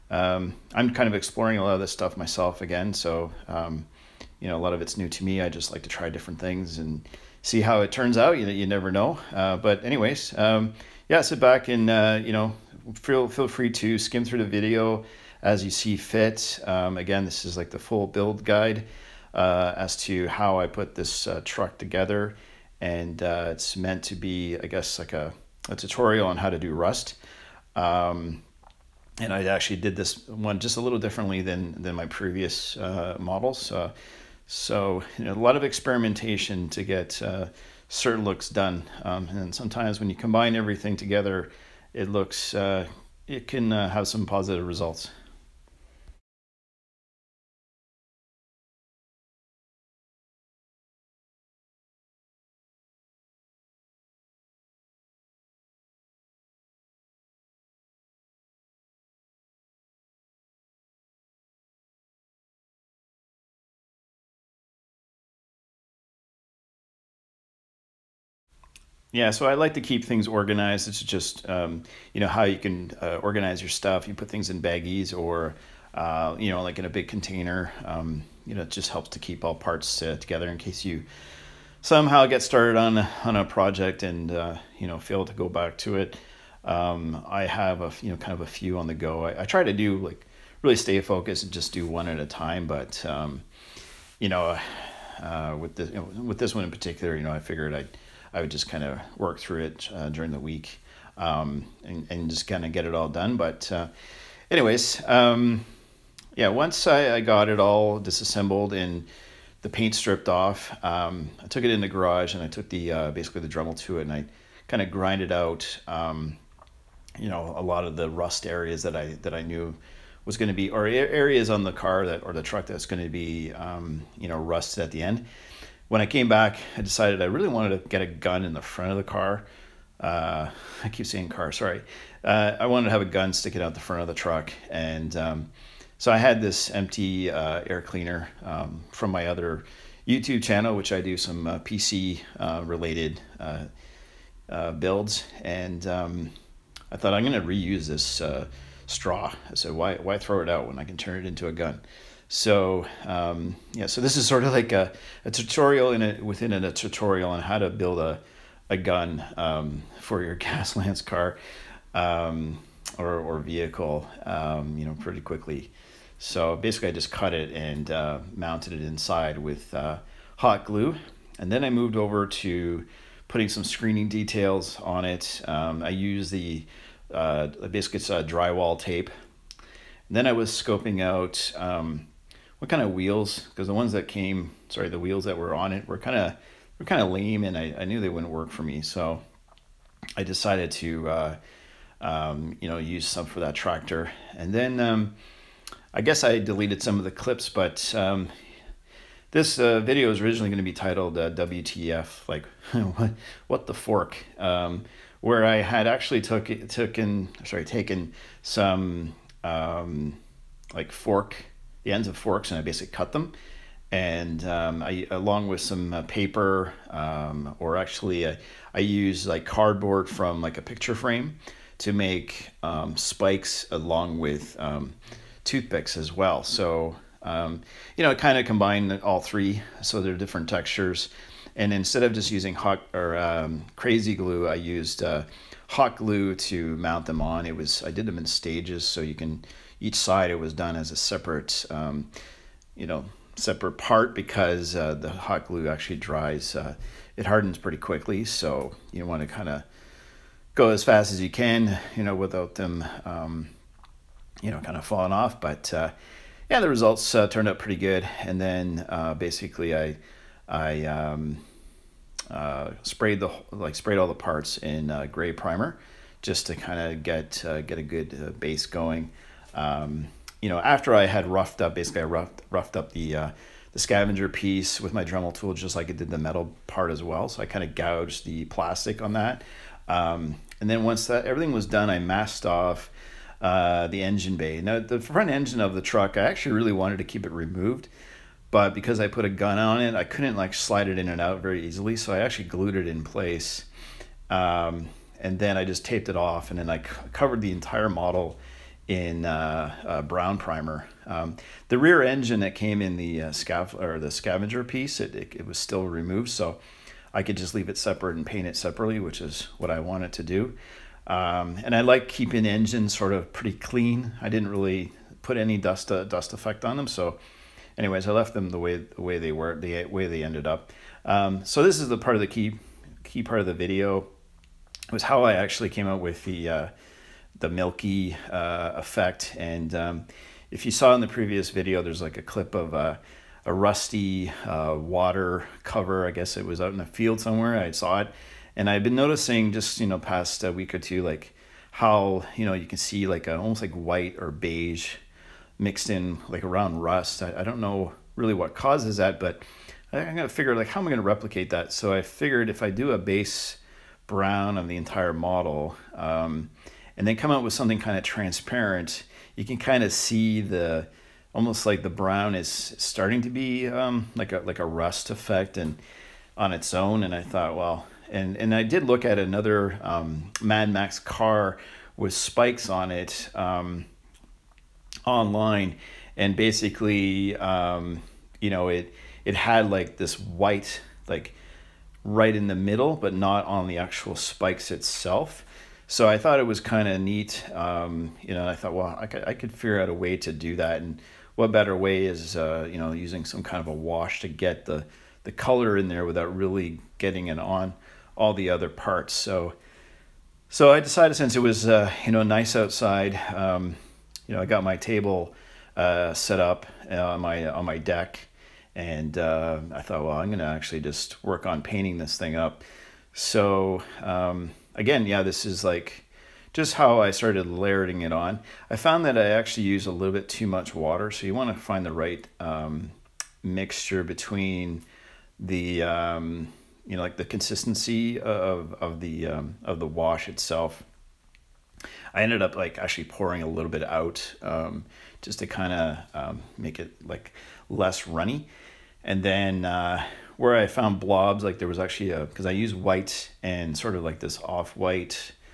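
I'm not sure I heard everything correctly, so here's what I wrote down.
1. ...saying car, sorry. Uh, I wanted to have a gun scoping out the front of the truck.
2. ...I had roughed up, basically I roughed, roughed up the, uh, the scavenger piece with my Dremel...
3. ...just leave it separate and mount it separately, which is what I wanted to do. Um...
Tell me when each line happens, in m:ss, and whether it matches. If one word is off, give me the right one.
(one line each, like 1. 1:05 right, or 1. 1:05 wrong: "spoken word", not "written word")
1. 2:11 wrong: "sticking", not "scoping"
2. 4:30 right
3. 5:07 wrong: "paint", not "mount".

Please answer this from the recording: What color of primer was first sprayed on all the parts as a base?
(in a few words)
gray.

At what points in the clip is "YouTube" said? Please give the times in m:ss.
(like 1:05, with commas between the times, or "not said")
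2:20.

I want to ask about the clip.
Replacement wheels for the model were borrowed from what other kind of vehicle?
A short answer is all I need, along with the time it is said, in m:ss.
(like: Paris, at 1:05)
tractor, at 3:13.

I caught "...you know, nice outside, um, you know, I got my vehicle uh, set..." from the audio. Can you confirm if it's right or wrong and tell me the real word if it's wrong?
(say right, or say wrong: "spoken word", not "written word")
wrong: "table", not "vehicle".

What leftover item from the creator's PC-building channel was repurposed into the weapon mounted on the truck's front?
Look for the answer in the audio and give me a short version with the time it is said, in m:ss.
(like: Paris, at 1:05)
air cleaner, at 2:17.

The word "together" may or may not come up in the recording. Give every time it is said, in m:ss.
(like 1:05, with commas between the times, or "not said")
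0:21, 0:40, 1:20.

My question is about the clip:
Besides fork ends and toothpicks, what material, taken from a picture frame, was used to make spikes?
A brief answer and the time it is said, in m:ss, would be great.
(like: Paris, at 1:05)
cardboard, at 3:39.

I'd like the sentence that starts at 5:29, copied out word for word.
And um, if you saw in the previous video, there's like a clip of a, a rusty uh, water cover.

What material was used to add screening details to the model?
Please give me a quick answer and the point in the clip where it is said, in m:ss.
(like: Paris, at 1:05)
drywall tape, at 2:58.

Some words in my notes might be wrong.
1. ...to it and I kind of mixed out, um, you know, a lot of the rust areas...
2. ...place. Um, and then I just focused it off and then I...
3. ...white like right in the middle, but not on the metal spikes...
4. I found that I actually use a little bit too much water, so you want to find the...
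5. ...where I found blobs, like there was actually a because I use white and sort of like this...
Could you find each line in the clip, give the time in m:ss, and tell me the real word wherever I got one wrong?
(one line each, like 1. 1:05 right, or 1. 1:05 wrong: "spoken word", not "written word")
1. 1:53 wrong: "grinded", not "mixed"
2. 4:53 wrong: "taped", not "focused"
3. 6:20 wrong: "actual", not "metal"
4. 6:58 right
5. 7:20 right.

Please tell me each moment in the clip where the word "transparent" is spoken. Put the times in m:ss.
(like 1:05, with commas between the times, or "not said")
5:58.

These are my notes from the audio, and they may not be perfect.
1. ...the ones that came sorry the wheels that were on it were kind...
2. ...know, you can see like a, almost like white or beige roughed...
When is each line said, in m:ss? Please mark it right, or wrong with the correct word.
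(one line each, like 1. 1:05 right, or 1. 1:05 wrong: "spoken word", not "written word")
1. 3:03 right
2. 5:42 wrong: "mixed", not "roughed".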